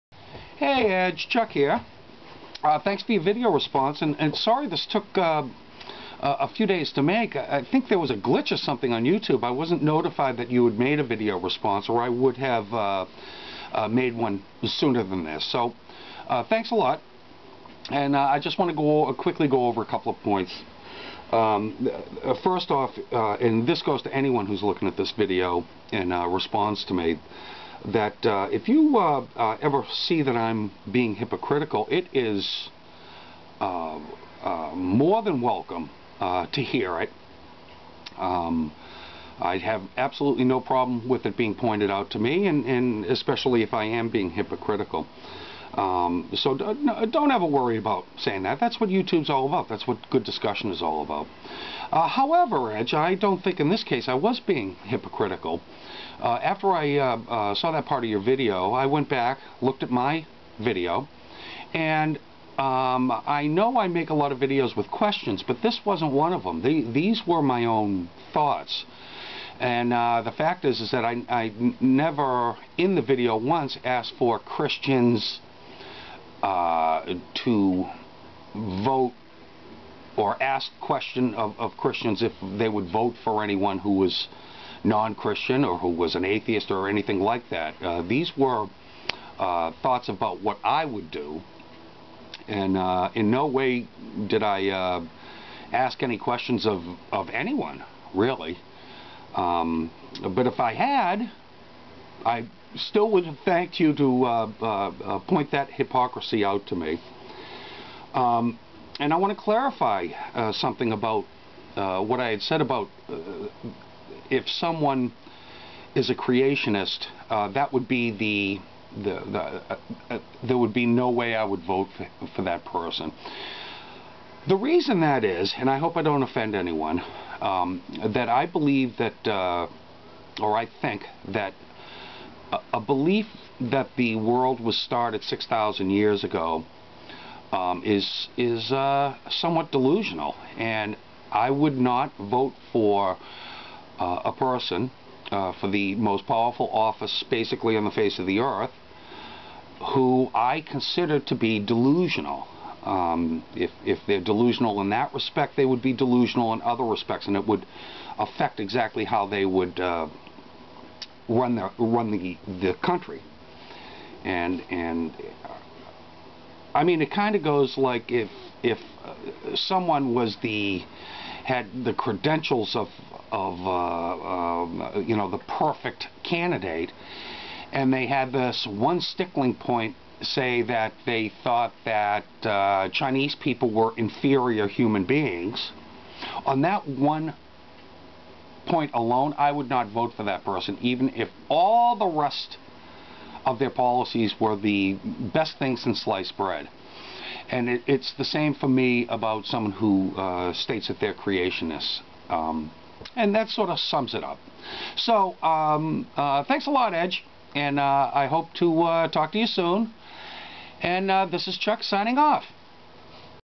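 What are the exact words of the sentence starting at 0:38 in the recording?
Um, I have absolutely no problem with it being pointed out to me, and, and especially if I am being hypocritical.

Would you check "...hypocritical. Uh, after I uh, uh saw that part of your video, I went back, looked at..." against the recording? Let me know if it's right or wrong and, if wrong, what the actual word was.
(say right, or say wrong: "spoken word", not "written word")
right.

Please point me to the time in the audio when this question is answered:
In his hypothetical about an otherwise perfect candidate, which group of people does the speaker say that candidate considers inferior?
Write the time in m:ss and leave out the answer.
3:02.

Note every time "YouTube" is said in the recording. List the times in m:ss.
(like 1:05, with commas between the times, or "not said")
0:09, 0:48.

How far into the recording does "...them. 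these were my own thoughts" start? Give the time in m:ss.
1:06.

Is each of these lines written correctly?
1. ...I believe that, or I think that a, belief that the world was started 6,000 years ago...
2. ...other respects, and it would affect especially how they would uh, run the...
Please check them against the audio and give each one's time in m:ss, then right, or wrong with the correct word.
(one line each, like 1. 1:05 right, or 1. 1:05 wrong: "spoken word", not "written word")
1. 2:08 right
2. 2:36 wrong: "exactly", not "especially".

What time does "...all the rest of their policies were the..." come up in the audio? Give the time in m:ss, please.
3:11.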